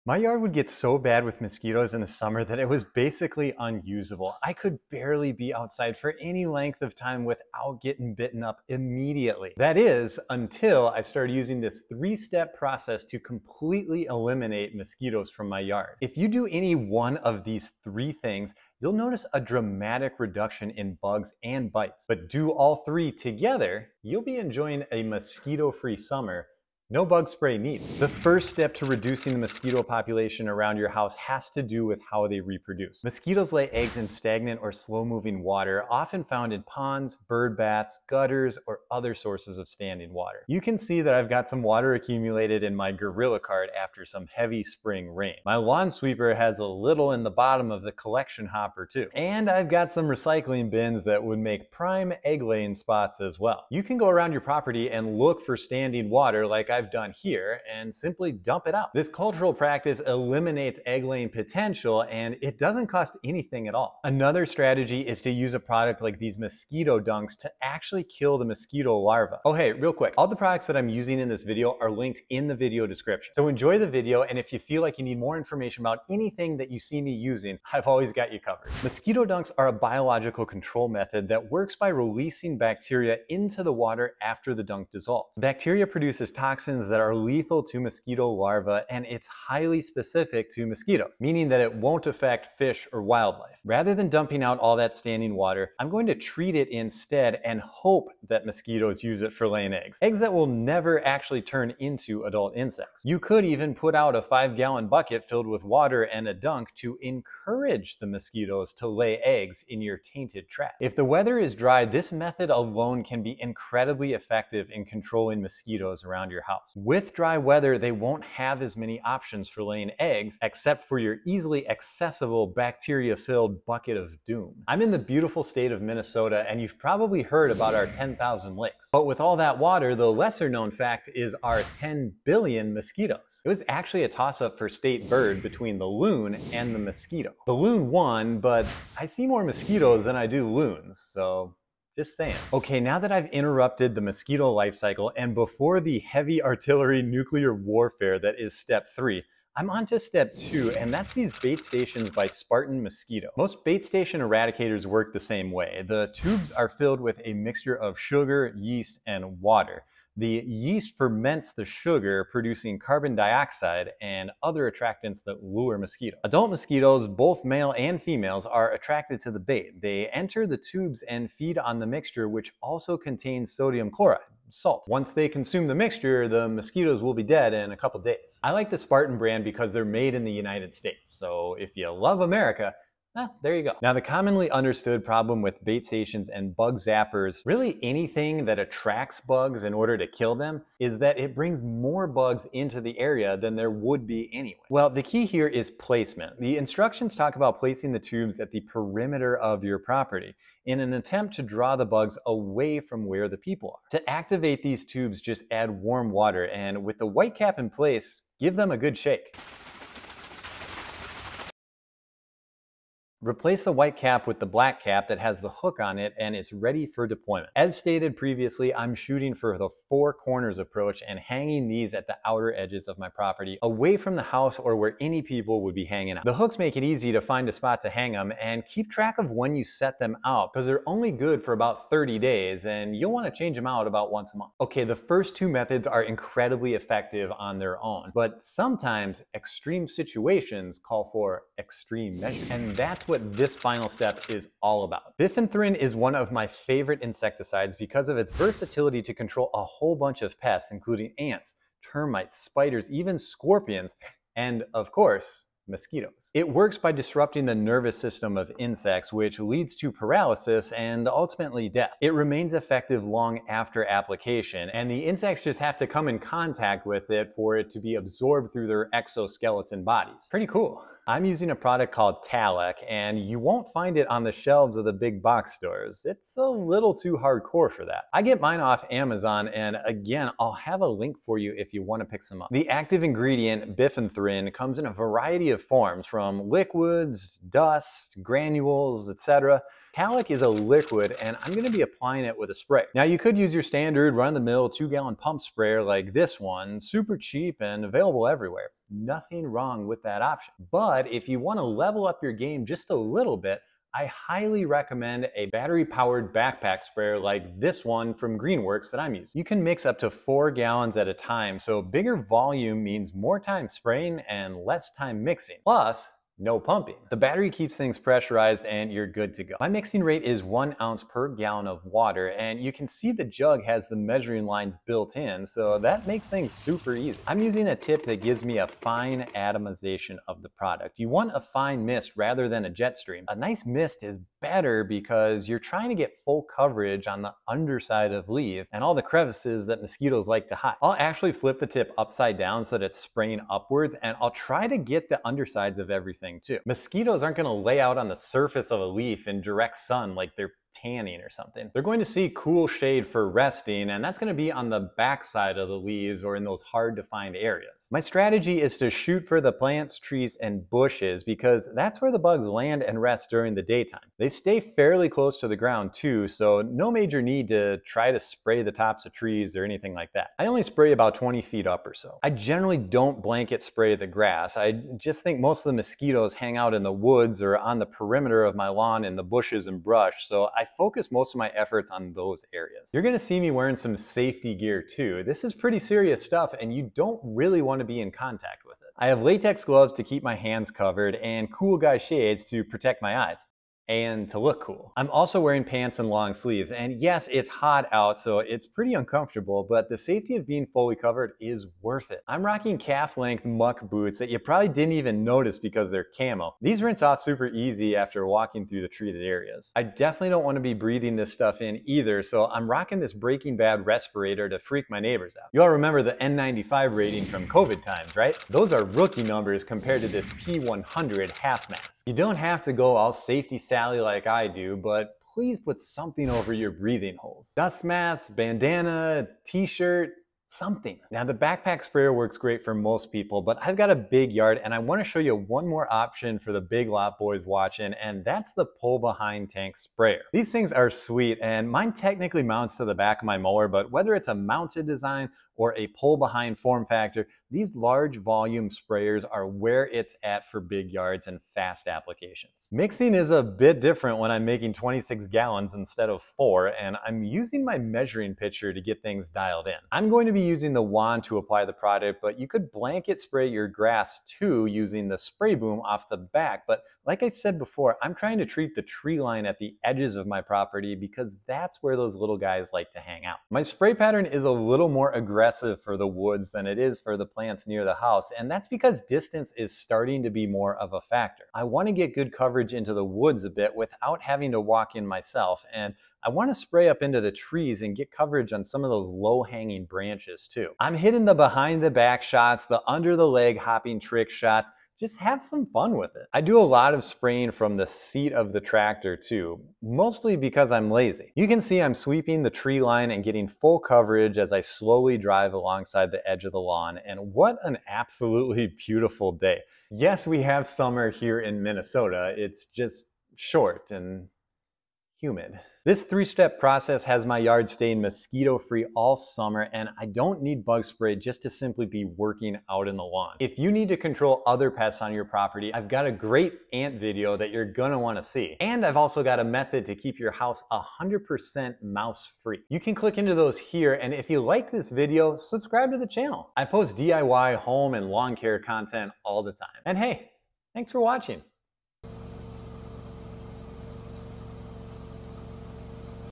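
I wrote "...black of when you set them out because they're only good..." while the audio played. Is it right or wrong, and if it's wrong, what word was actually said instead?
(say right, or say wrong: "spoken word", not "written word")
wrong: "track", not "black".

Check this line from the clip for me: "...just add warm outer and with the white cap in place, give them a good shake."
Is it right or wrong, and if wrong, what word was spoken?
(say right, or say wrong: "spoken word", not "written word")
wrong: "water", not "outer".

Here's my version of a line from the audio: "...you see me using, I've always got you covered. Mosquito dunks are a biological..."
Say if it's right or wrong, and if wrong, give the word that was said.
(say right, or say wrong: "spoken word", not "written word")
right.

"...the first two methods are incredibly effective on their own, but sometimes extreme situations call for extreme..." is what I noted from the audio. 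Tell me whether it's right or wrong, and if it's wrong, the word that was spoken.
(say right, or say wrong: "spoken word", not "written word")
right.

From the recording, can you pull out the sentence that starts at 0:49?
And I've got some recycling bins that would make prime egg laying spots as well.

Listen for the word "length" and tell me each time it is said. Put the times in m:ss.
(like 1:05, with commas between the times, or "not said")
0:06, 6:42.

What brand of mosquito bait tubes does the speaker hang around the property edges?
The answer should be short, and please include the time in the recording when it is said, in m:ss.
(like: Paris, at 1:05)
Spartan Mosquito, at 2:32.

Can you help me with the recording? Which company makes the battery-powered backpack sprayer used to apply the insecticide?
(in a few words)
Greenworks.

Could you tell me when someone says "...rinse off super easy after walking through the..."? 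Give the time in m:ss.
6:46.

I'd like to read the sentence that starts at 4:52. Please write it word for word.
Now you could use your standard run-of-the-mill two gallon pump sprayer like this one, super cheap and available everywhere.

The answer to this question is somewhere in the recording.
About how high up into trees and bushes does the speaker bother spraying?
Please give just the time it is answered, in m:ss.
6:11.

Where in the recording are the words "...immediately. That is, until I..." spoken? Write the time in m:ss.
0:08.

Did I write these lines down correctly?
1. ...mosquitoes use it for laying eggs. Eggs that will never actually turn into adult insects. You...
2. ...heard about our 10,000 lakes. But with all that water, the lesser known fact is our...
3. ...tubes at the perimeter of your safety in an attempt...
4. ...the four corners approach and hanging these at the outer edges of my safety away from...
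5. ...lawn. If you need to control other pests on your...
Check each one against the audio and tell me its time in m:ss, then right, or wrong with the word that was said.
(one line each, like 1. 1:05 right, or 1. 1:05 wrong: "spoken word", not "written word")
1. 1:38 right
2. 2:07 right
3. 3:17 wrong: "property", not "safety"
4. 3:39 wrong: "property", not "safety"
5. 8:43 right.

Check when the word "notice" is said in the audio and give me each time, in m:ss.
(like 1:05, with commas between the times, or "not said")
0:18, 6:45.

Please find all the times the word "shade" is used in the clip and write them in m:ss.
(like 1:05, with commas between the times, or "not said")
5:52, 6:31.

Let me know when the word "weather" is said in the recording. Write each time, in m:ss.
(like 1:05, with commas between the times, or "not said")
1:51, 1:57.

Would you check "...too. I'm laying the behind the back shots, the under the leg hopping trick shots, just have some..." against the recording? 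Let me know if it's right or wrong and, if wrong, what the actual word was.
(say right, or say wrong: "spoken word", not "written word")
wrong: "hitting", not "laying".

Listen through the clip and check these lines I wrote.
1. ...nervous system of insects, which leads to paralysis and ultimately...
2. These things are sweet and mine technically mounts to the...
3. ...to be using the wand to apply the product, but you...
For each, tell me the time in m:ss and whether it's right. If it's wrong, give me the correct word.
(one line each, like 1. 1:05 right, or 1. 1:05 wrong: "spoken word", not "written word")
1. 4:17 right
2. 7:20 right
3. 7:40 right.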